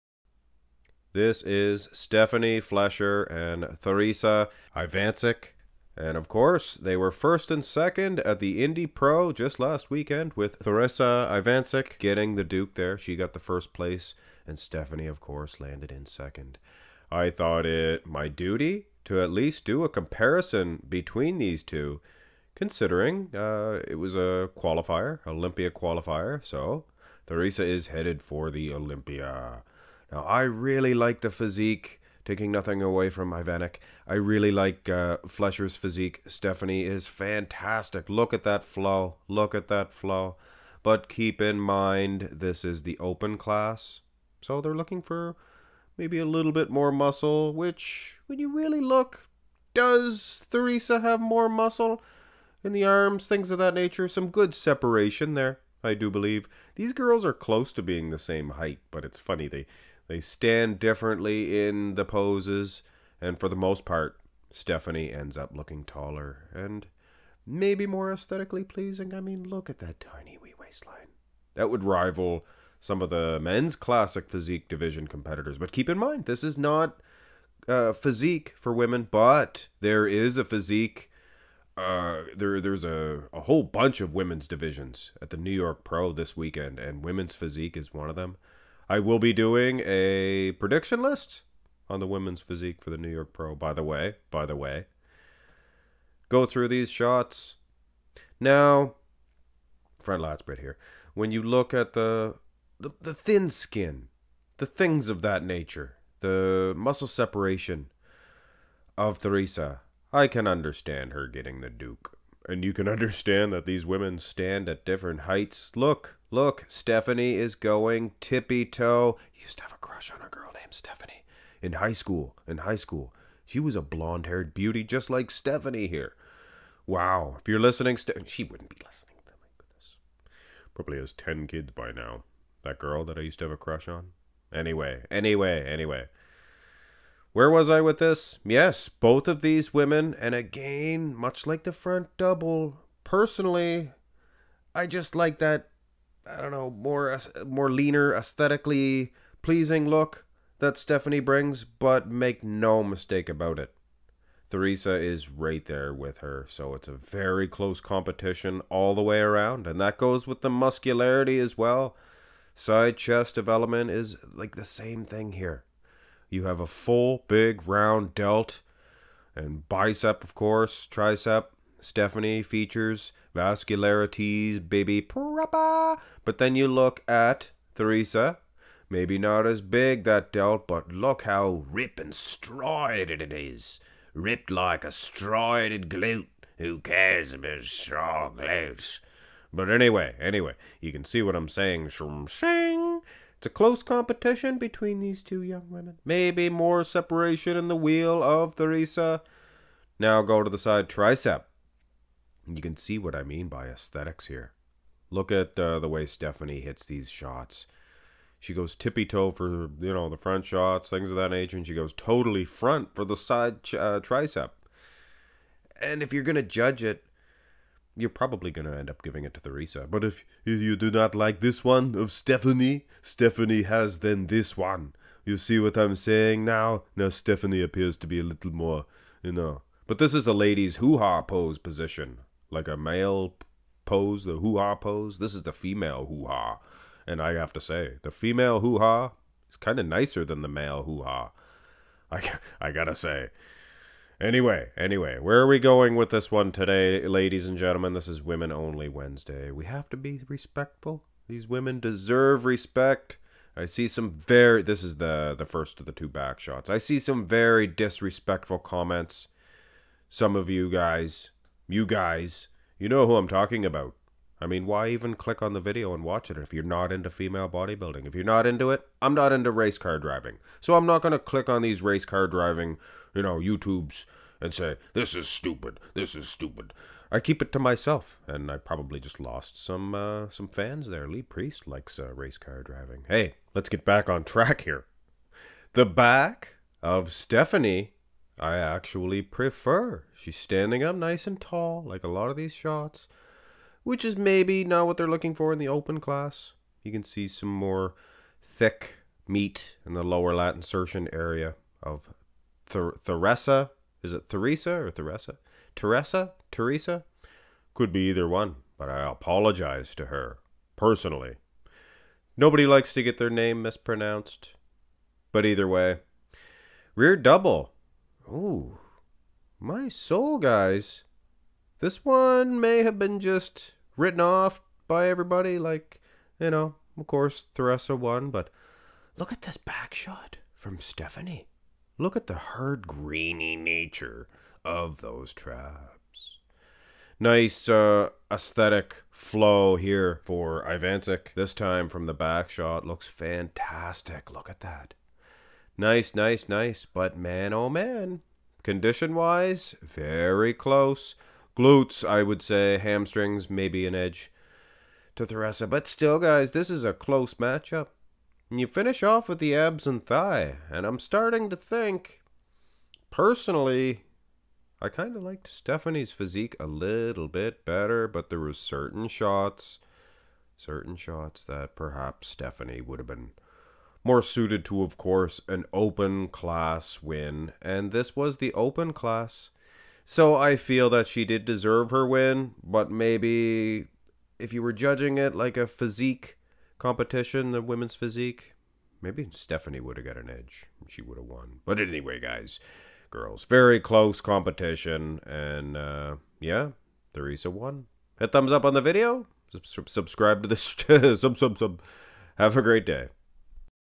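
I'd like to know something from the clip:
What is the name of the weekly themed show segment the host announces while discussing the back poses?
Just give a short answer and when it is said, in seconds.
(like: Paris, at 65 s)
Women Only Wednesday, at 248 s.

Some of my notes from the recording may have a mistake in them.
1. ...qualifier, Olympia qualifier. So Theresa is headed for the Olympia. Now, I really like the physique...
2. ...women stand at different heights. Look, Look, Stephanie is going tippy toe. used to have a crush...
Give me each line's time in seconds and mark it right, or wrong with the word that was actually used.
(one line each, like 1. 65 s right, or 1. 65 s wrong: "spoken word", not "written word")
1. 24 s right
2. 113 s right.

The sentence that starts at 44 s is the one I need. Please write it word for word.
So they're looking for maybe a little bit more muscle, which, when you really look, does Theresa have more muscle?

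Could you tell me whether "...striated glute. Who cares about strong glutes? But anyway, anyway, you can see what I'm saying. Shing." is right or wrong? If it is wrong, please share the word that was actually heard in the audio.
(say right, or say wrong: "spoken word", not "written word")
right.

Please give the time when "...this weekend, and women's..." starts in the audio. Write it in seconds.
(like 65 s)
86 s.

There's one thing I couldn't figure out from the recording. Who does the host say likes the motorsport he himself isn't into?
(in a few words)
Lee Priest.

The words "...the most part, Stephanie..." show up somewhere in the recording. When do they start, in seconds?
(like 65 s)
63 s.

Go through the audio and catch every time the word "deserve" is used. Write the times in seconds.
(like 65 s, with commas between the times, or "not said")
251 s, 381 s.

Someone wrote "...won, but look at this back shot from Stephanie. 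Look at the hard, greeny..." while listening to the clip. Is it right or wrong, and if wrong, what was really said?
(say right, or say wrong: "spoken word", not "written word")
right.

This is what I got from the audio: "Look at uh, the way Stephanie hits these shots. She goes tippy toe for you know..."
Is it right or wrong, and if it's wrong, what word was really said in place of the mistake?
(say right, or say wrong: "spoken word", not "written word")
right.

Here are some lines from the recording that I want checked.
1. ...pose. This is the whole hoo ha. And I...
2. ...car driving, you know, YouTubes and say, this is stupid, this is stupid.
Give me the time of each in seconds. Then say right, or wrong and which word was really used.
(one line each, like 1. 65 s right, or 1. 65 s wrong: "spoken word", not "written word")
1. 234 s wrong: "female", not "whole"
2. 272 s right.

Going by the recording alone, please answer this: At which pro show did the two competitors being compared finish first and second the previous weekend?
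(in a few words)
Indy Pro.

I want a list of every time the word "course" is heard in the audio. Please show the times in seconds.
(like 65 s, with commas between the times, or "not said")
6 s, 15 s, 170 s, 327 s, 374 s.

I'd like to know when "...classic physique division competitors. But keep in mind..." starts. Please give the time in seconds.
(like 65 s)
73 s.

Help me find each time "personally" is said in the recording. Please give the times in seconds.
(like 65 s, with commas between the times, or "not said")
143 s, 310 s, 363 s.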